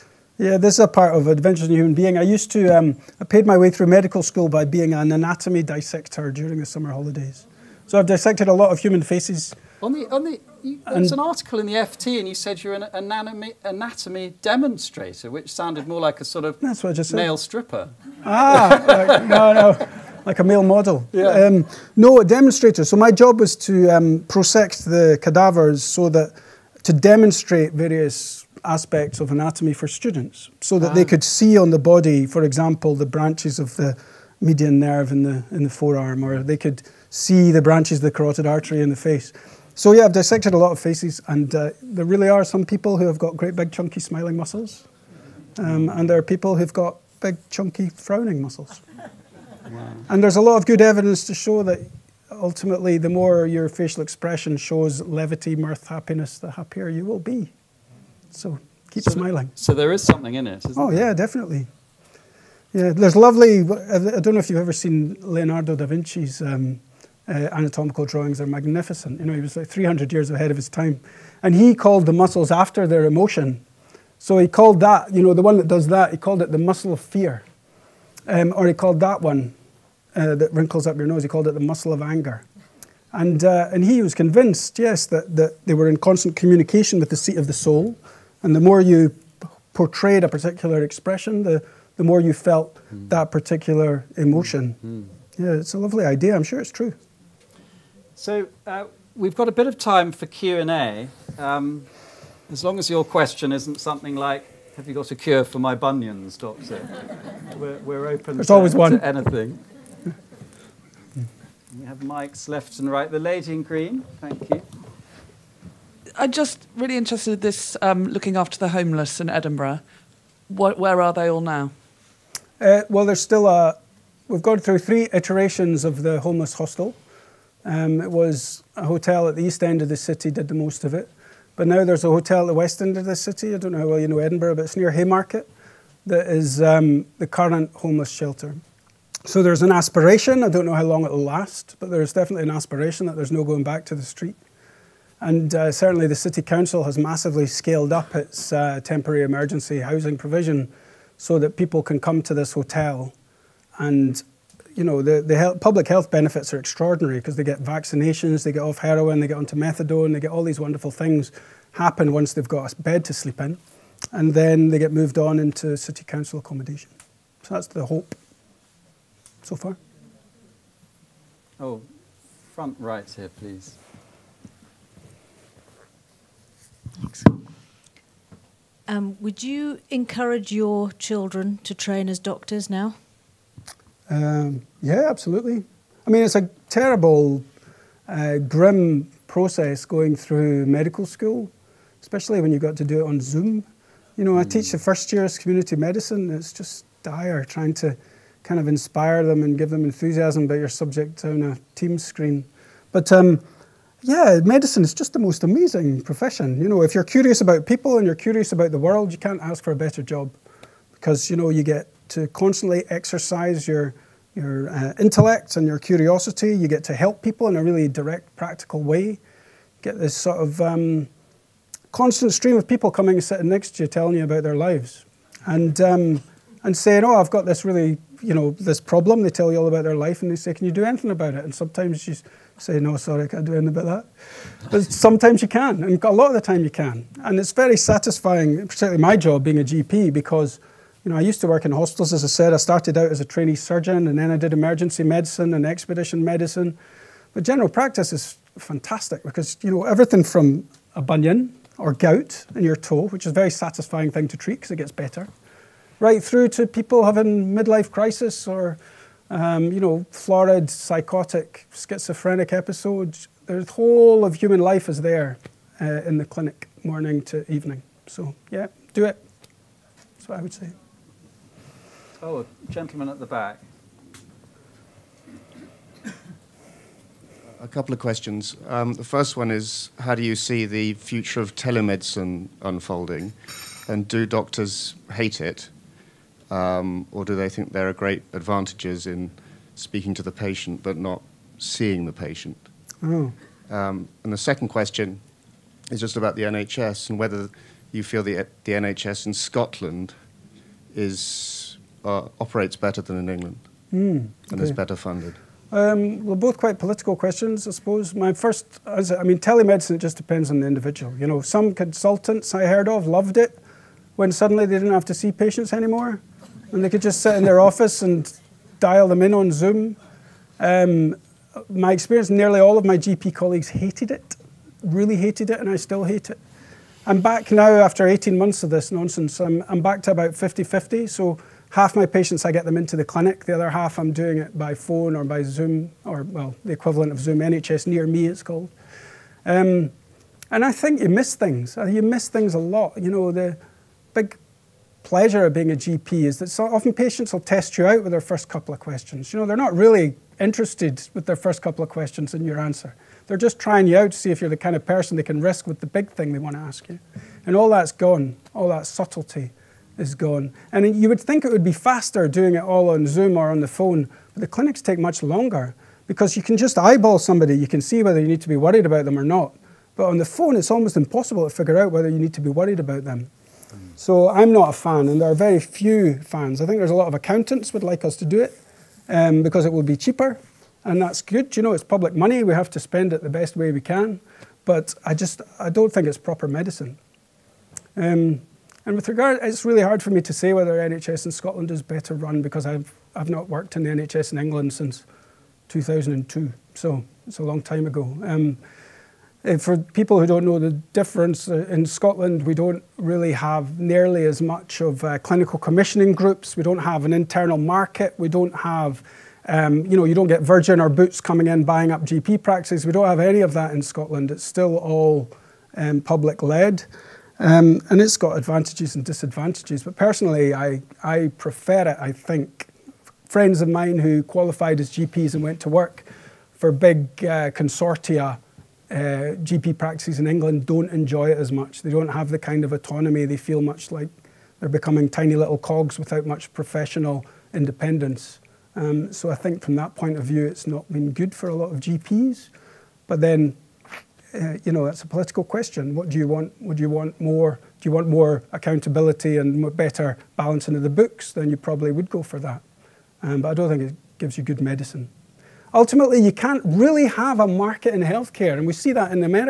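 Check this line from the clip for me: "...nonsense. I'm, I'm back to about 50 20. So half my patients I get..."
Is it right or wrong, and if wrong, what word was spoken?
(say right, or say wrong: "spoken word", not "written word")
wrong: "50", not "20".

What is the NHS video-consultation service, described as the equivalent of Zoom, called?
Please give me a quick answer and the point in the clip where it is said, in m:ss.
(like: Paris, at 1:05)
NHS Near Me, at 5:37.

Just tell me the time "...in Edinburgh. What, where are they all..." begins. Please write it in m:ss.
1:59.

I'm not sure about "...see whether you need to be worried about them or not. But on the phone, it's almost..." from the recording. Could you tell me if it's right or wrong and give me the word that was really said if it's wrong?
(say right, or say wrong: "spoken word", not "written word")
right.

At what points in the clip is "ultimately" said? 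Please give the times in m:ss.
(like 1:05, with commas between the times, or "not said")
0:52, 7:35.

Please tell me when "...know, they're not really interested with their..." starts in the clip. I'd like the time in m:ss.
5:49.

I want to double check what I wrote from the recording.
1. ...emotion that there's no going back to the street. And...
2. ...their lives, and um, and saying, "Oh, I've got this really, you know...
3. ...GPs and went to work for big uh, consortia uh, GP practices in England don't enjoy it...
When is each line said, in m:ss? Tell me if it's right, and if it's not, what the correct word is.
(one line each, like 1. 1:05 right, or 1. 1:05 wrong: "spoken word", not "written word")
1. 2:22 wrong: "aspiration", not "emotion"
2. 3:44 right
3. 7:04 right.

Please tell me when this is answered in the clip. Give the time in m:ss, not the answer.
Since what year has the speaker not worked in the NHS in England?
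6:35.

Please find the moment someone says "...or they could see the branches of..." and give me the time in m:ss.
0:36.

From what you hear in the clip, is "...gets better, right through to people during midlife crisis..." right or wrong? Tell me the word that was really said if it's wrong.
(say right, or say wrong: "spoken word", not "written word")
wrong: "having", not "during".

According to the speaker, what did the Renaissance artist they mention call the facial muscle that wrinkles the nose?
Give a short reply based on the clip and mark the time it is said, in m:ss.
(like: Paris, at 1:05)
the muscle of anger, at 1:21.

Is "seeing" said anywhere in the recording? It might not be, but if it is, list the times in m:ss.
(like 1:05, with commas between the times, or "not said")
4:51.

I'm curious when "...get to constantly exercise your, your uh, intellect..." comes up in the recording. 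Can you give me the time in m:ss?
3:31.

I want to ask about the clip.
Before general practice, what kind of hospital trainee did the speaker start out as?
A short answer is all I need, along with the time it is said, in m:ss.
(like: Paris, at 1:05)
trainee surgeon, at 4:03.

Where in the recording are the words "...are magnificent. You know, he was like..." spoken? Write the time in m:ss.
1:08.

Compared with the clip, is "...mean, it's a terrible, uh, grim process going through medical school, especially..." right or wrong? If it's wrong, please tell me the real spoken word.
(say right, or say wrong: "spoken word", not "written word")
right.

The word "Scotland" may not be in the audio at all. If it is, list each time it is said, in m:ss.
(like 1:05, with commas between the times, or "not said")
4:59, 6:31, 6:41, 6:53.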